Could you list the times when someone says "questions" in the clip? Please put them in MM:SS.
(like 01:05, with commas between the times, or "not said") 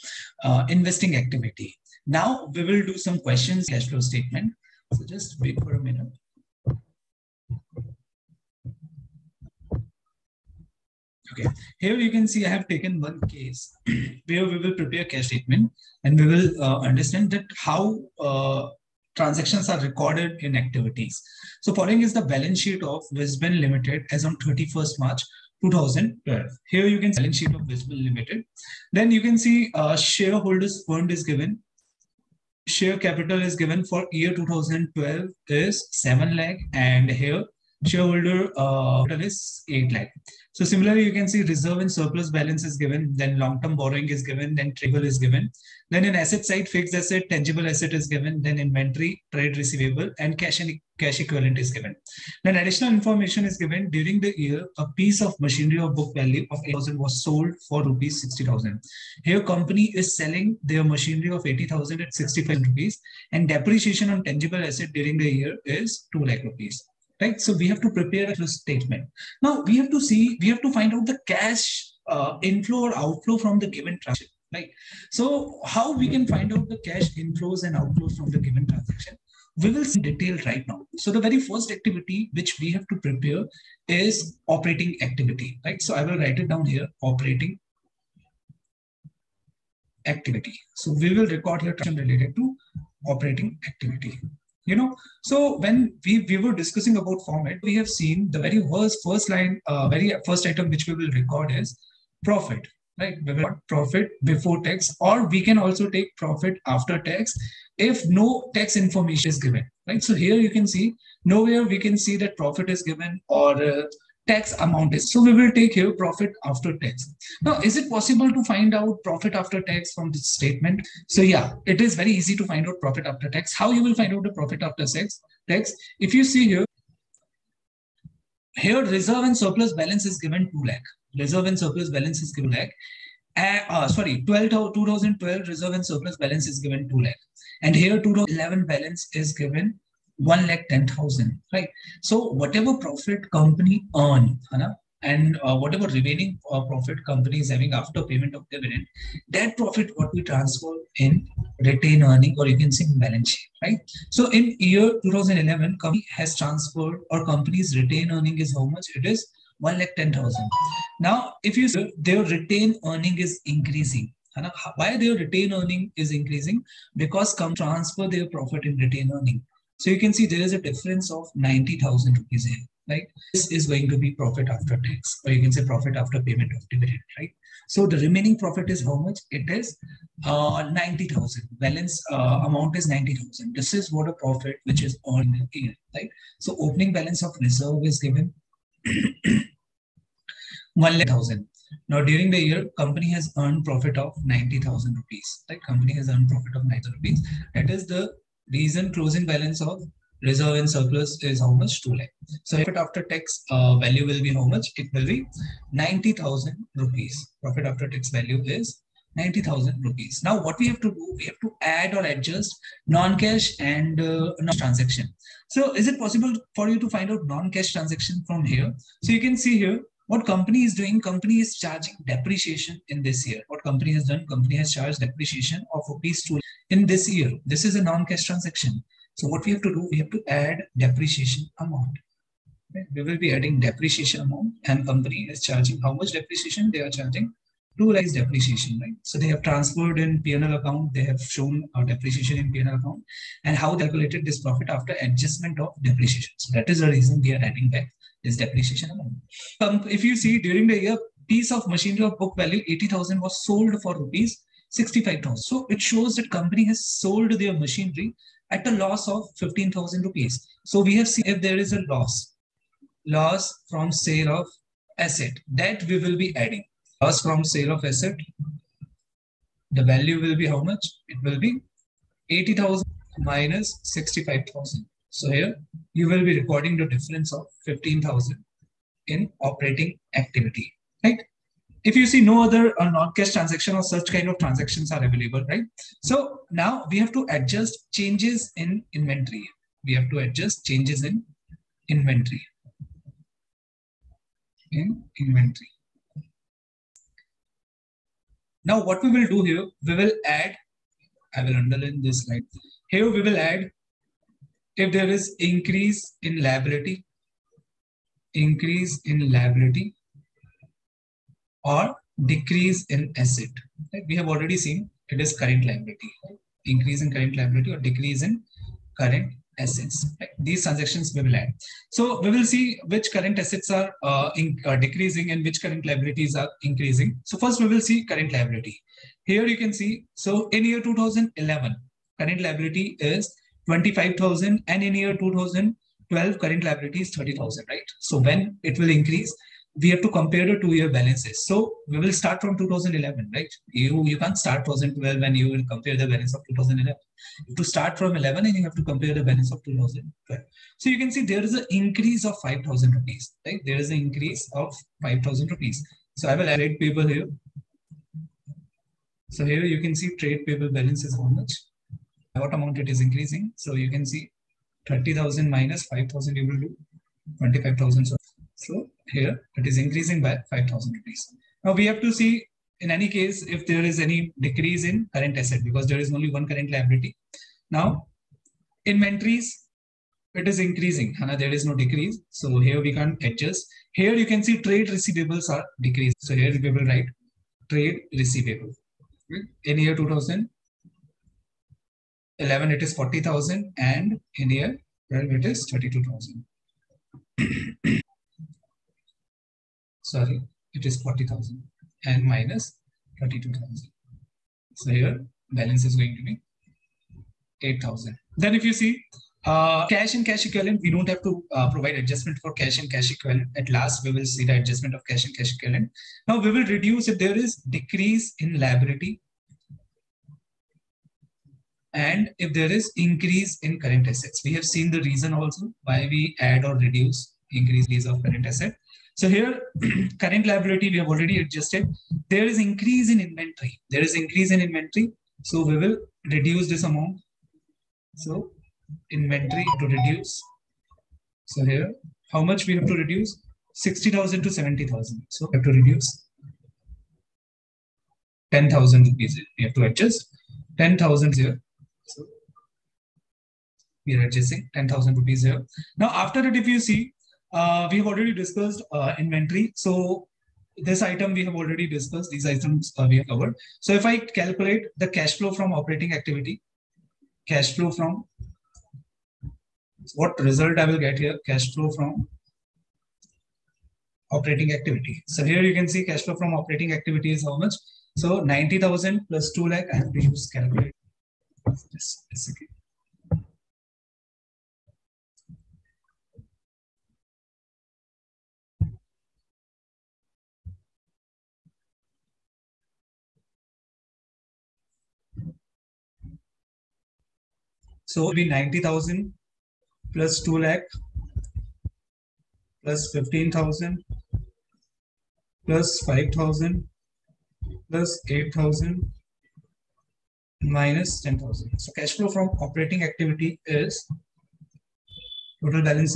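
00:03.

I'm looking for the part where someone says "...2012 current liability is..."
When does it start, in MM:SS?
05:35.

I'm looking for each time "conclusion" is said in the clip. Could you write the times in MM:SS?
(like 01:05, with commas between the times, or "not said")
not said.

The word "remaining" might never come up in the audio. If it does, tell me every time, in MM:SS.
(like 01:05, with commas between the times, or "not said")
02:25, 02:57.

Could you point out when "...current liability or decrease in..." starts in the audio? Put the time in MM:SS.
05:17.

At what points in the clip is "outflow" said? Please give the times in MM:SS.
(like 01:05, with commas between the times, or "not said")
01:12, 01:17.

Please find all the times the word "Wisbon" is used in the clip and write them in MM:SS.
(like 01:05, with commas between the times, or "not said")
00:23, 00:27.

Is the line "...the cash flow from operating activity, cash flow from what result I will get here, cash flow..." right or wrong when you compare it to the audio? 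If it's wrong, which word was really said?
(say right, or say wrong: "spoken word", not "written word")
right.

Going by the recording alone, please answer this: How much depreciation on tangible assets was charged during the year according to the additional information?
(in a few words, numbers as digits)
2 lakh rupees.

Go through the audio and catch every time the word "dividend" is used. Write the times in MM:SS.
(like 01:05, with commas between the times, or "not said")
02:28, 02:56.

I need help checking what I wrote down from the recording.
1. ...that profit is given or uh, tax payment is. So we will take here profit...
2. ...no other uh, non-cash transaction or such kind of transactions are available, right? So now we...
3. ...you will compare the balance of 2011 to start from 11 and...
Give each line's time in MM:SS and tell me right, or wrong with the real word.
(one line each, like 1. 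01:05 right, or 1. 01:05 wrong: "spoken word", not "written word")
1. 01:52 wrong: "amount", not "payment"
2. 04:42 right
3. 05:45 right.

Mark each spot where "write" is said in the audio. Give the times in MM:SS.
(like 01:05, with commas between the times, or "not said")
01:26, 06:26.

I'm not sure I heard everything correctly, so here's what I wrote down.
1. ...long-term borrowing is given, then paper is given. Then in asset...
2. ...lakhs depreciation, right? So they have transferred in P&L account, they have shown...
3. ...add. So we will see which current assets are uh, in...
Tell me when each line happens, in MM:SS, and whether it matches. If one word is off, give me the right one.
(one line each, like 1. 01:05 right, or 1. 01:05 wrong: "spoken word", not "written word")
1. 00:43 wrong: "trigger", not "paper"
2. 03:57 right
3. 05:21 right.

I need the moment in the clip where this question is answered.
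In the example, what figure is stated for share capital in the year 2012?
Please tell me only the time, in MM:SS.
00:35.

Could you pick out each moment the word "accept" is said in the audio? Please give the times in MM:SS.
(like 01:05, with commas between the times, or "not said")
not said.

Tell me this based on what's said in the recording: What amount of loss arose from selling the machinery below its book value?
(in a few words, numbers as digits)
15,000.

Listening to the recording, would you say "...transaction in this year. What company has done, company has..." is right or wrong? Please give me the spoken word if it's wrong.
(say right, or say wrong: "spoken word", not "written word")
wrong: "depreciation", not "transaction".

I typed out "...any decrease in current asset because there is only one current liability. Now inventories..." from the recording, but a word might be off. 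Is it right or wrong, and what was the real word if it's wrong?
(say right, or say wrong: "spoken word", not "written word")
right.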